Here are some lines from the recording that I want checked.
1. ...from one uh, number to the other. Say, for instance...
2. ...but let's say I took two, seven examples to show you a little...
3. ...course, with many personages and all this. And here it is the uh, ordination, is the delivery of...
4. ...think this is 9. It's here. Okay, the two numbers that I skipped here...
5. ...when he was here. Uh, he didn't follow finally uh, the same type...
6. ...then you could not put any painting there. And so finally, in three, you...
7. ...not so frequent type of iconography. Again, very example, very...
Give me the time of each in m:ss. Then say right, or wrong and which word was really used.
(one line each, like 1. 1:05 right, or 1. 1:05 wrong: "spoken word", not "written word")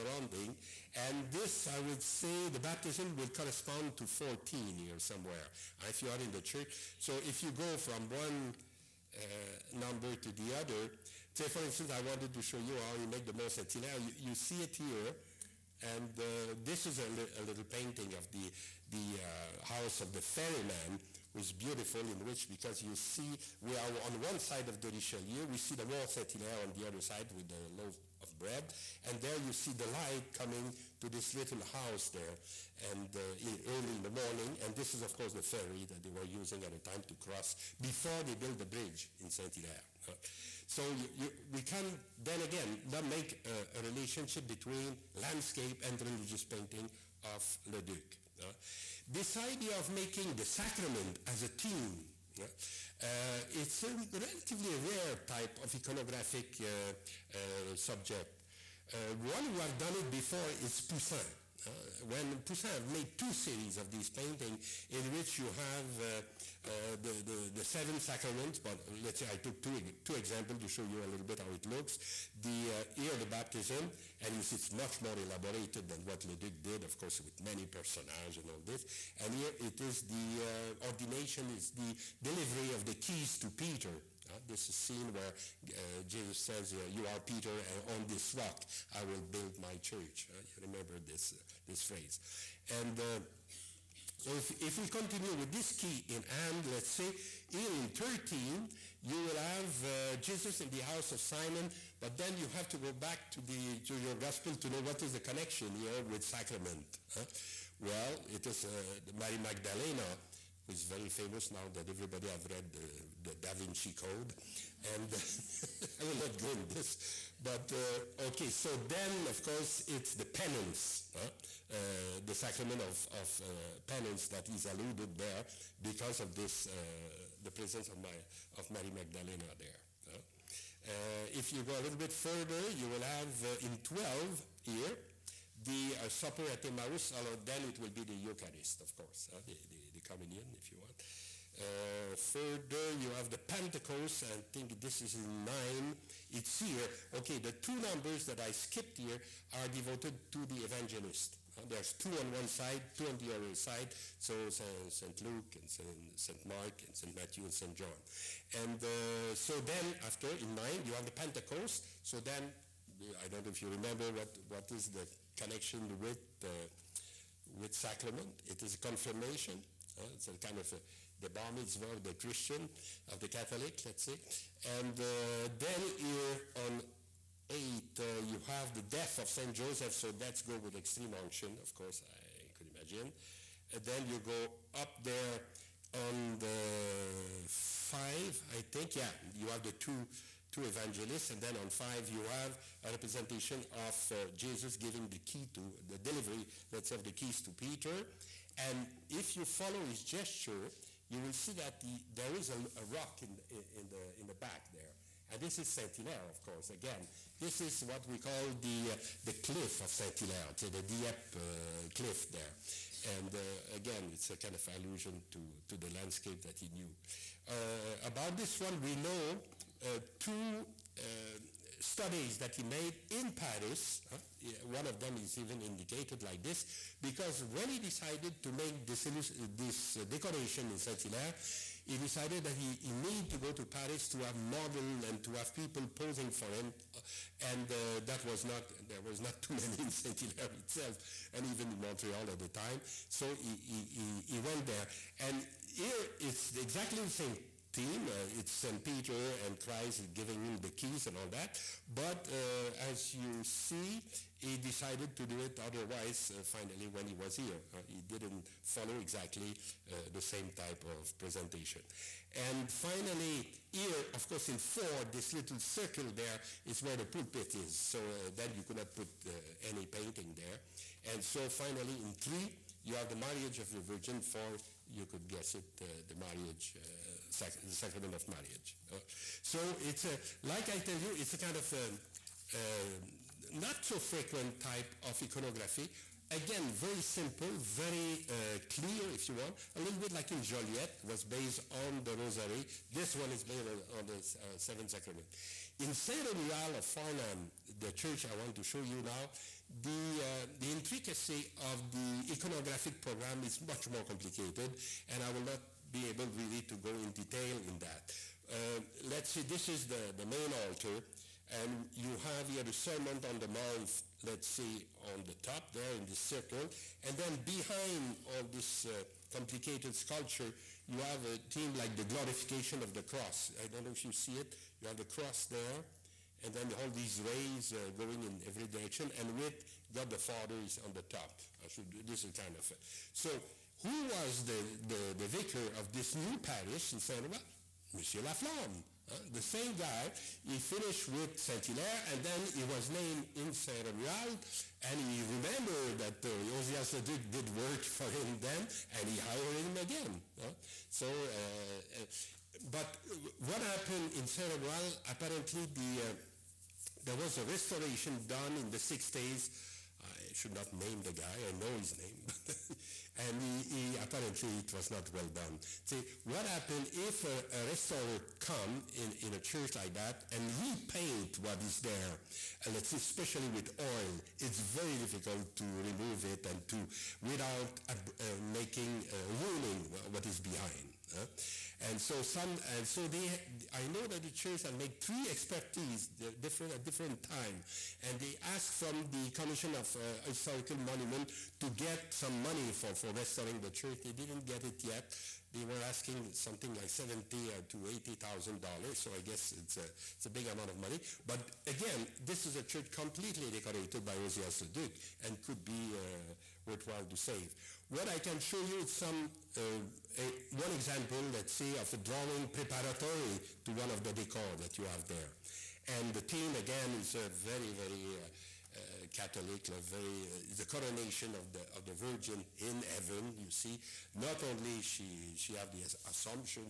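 1. 0:07 right
2. 1:08 wrong: "two", not "seven"
3. 1:17 right
4. 2:24 right
5. 4:16 wrong: "exactly", not "finally"
6. 4:28 right
7. 4:43 wrong: "simple", not "example".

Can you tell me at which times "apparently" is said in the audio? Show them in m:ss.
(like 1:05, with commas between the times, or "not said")
5:55, 6:03.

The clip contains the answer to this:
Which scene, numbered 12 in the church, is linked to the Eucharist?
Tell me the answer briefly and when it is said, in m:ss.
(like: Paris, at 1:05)
The supper at Emmaus, at 2:15.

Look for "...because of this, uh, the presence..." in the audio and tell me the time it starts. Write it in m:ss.
2:05.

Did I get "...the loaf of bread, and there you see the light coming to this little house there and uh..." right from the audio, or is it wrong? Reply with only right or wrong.
right.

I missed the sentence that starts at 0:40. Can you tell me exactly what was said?
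so you, you, we can then again not make a relationship between landscape and religious painting of Leduc.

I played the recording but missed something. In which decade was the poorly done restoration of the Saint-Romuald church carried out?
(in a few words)
1960s.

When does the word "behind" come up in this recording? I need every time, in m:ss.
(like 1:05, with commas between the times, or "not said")
5:17, 6:20.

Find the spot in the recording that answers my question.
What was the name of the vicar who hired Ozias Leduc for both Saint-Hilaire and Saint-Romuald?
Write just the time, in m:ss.
5:37.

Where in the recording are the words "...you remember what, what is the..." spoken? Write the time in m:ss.
2:43.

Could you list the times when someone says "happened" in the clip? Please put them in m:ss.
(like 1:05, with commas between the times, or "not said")
5:53, 6:06.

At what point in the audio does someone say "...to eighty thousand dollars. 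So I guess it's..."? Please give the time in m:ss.
6:37.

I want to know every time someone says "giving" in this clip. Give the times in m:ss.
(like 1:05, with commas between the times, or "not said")
3:14, 4:10.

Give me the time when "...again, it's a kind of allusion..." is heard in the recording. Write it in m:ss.
3:33.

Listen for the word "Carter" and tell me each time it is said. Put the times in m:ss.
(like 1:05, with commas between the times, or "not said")
not said.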